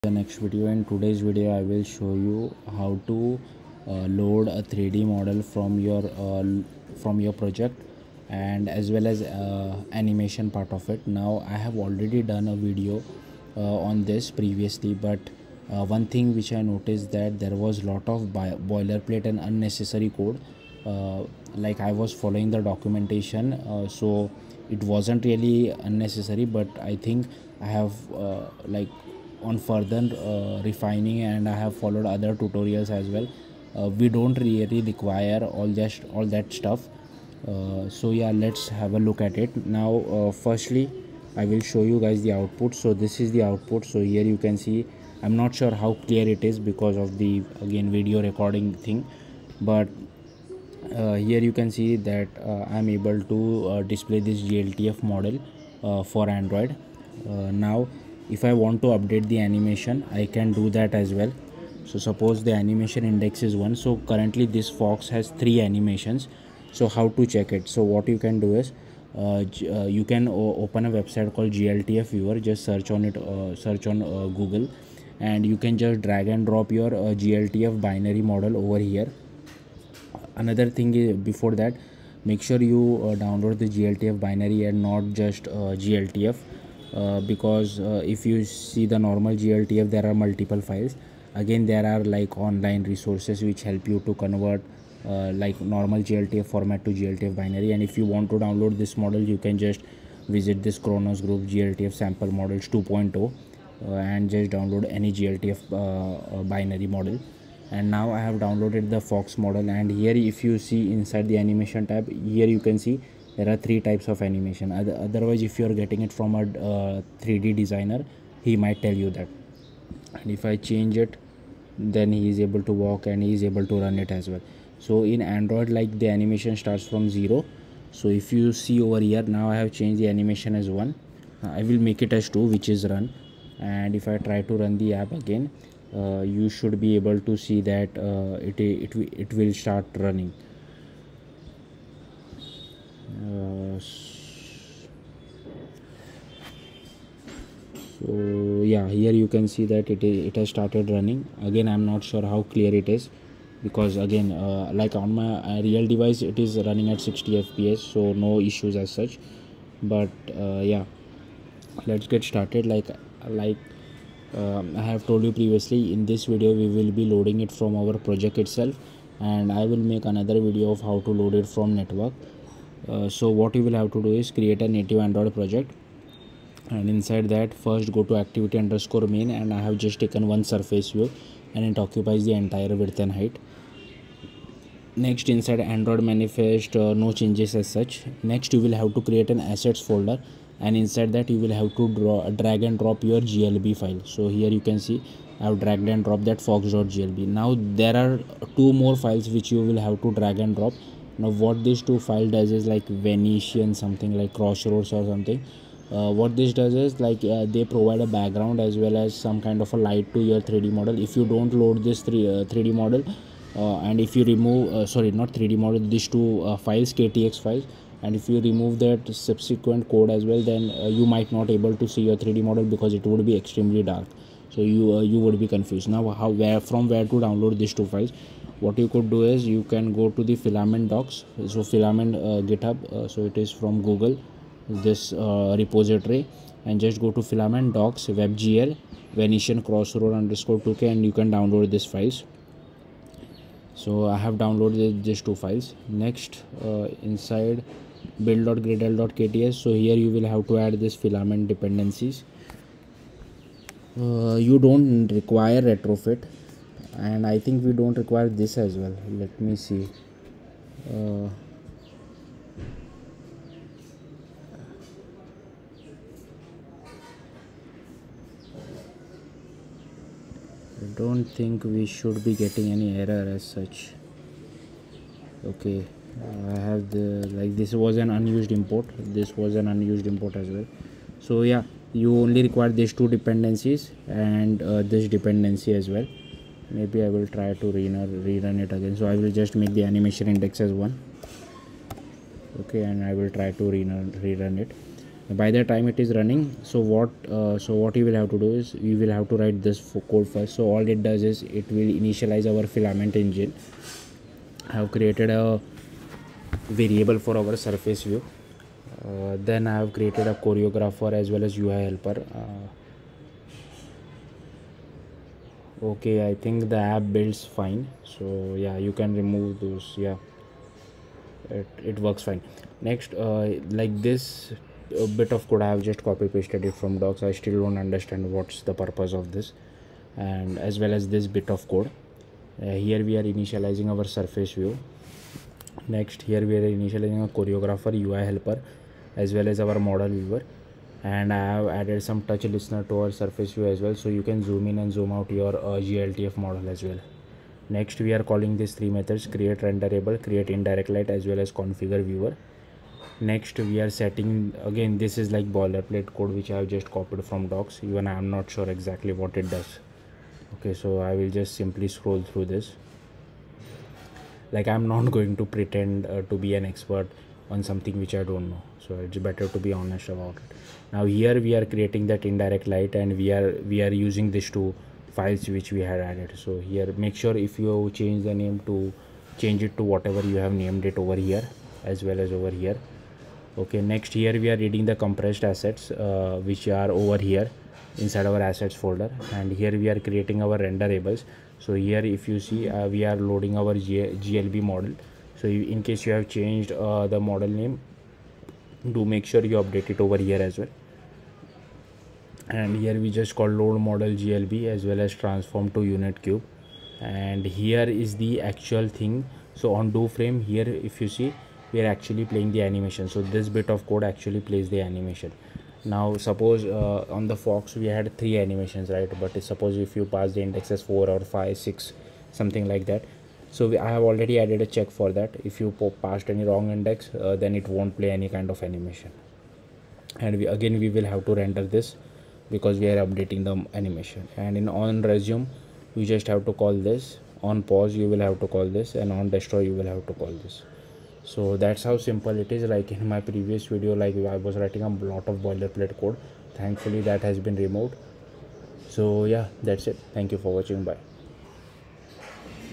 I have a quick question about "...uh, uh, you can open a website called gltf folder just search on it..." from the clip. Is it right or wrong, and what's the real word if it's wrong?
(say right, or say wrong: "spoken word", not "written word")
wrong: "viewer", not "folder".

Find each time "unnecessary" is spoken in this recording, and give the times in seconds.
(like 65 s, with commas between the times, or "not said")
19 s, 25 s.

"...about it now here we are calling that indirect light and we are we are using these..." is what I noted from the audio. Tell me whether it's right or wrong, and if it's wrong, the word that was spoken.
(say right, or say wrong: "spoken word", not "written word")
wrong: "creating", not "calling".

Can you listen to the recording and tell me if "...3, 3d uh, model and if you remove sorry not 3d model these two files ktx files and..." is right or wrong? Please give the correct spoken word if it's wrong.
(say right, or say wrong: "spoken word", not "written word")
right.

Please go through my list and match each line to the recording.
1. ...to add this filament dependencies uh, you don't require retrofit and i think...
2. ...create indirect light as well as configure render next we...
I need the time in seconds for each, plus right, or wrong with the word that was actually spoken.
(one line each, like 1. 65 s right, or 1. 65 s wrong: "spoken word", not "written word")
1. 250 s right
2. 350 s wrong: "viewer", not "render".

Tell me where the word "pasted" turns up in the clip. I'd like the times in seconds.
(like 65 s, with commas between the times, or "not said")
326 s.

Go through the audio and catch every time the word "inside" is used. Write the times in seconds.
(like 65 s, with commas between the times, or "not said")
110 s, 176 s, 185 s, 190 s, 247 s, 387 s.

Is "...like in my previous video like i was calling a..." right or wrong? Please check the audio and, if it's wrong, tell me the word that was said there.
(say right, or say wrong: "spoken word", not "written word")
wrong: "writing", not "calling".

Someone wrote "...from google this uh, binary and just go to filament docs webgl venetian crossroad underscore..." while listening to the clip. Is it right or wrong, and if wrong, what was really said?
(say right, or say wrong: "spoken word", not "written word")
wrong: "repository", not "binary".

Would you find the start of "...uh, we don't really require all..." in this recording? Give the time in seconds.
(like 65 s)
33 s.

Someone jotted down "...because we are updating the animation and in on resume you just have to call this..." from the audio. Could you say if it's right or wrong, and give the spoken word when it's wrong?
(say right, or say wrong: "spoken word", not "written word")
right.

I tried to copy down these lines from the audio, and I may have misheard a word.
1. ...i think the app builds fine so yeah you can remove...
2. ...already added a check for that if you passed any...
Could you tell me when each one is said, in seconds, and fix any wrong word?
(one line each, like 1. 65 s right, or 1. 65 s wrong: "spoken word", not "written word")
1. 316 s right
2. 424 s right.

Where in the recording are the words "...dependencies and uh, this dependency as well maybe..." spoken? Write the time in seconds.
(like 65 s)
283 s.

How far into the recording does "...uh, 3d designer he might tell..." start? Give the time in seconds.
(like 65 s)
116 s.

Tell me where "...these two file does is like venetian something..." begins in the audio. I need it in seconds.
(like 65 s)
201 s.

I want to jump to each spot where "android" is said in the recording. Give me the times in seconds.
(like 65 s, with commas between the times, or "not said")
56 s, 125 s, 175 s, 185 s.